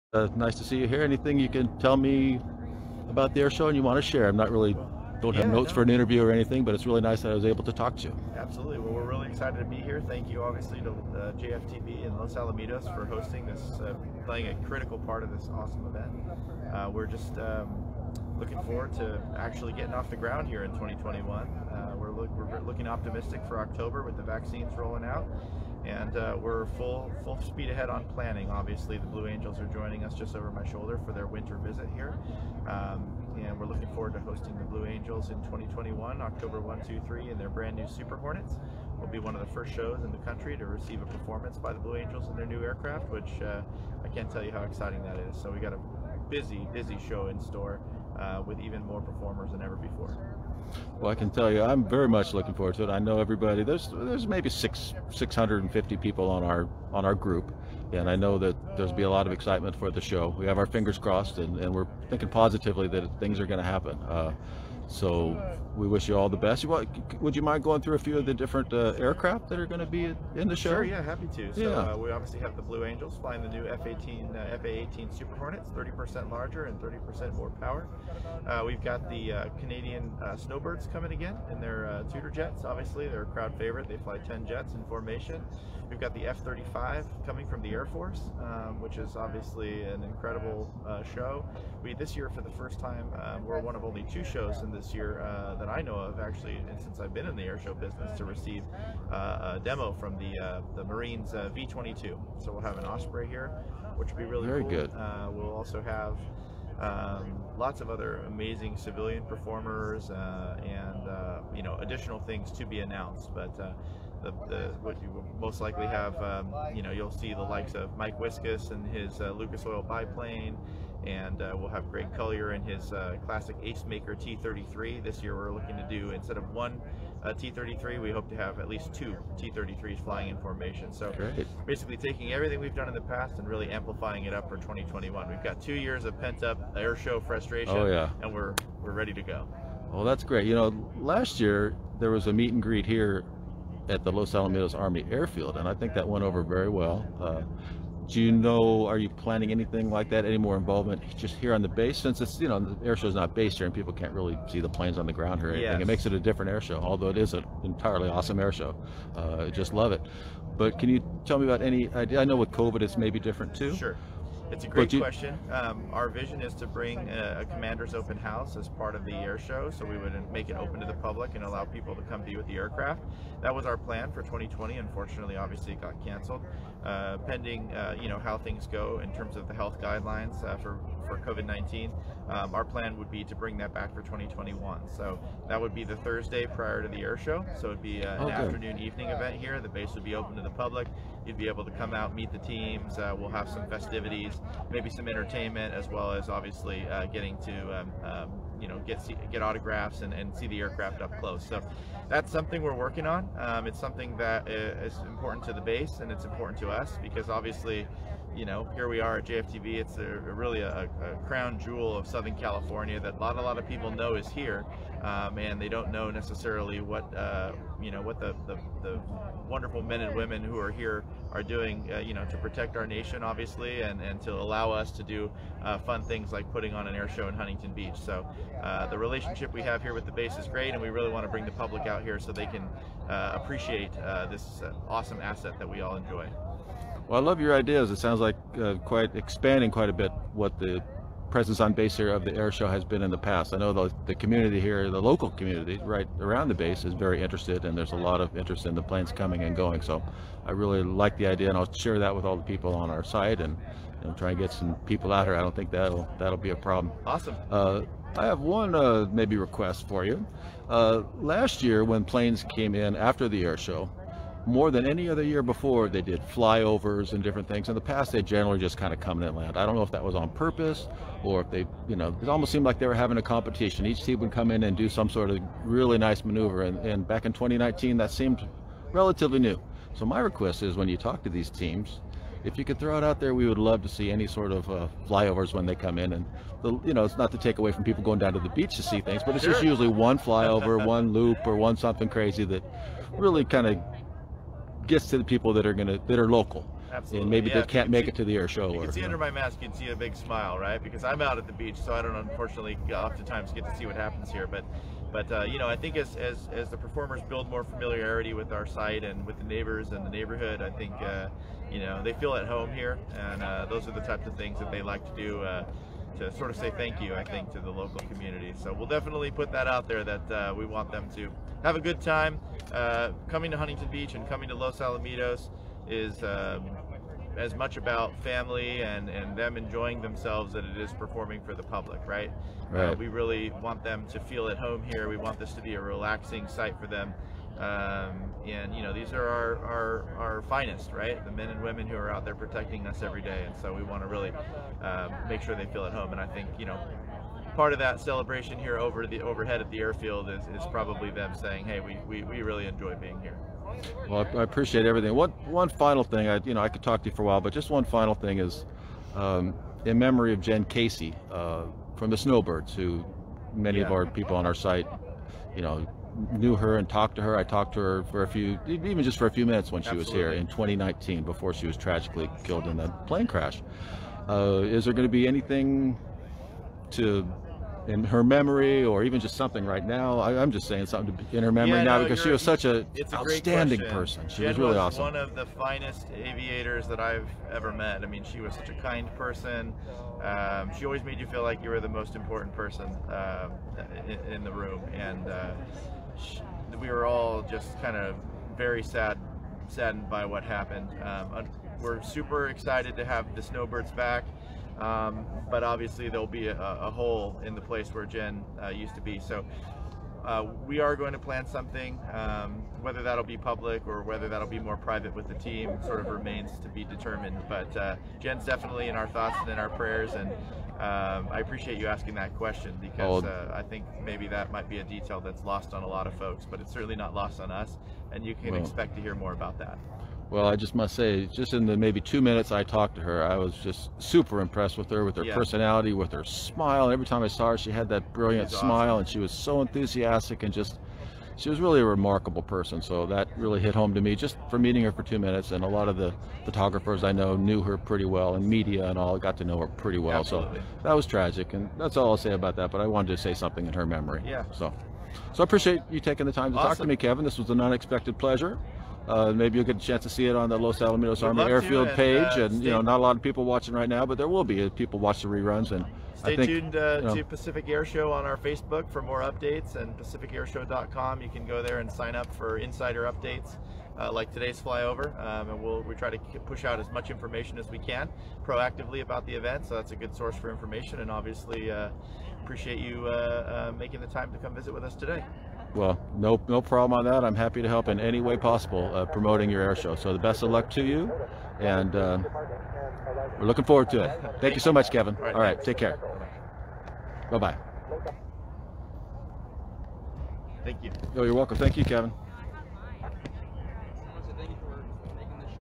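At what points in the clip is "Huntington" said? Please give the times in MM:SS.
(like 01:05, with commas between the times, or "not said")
03:47, 05:23.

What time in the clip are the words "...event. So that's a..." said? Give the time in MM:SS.
07:59.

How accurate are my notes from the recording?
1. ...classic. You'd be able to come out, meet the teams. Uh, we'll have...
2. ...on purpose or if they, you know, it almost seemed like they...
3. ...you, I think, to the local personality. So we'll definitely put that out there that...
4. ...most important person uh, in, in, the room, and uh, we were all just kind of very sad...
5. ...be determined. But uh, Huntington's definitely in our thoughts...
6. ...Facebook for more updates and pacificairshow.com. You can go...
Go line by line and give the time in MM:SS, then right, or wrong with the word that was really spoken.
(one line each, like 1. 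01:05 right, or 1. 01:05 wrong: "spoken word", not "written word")
1. 03:10 wrong: "public", not "classic"
2. 04:30 right
3. 05:17 wrong: "community", not "personality"
4. 06:31 right
5. 06:56 wrong: "Jen", not "Huntington"
6. 07:48 right.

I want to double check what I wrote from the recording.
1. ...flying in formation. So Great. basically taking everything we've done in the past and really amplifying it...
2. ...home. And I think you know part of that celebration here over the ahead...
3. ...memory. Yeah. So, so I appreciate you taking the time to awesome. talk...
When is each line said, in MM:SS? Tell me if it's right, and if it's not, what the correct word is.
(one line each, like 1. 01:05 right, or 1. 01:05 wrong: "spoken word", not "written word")
1. 02:10 right
2. 05:45 wrong: "overhead", not "ahead"
3. 07:33 right.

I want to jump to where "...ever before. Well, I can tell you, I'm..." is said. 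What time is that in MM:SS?
00:49.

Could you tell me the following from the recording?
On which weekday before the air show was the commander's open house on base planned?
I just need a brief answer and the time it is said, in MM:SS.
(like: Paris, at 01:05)
Thursday, at 03:05.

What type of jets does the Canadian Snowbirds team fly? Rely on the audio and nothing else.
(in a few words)
Tutor jets.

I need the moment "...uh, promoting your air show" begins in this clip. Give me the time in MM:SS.
08:08.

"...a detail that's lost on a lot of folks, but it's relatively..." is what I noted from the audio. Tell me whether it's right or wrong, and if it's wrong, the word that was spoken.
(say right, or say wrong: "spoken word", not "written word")
wrong: "certainly", not "relatively".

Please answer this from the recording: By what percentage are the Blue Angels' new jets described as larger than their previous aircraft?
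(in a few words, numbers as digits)
30%.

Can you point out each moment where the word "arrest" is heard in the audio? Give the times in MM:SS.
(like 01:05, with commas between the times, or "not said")
not said.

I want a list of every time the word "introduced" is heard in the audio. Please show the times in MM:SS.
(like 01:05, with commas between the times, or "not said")
not said.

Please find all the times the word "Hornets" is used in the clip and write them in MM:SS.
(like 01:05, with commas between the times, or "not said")
00:38, 01:15.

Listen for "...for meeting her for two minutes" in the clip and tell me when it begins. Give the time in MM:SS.
07:24.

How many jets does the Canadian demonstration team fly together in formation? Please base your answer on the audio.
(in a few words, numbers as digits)
10.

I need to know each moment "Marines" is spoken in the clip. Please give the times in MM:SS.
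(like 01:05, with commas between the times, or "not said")
01:40.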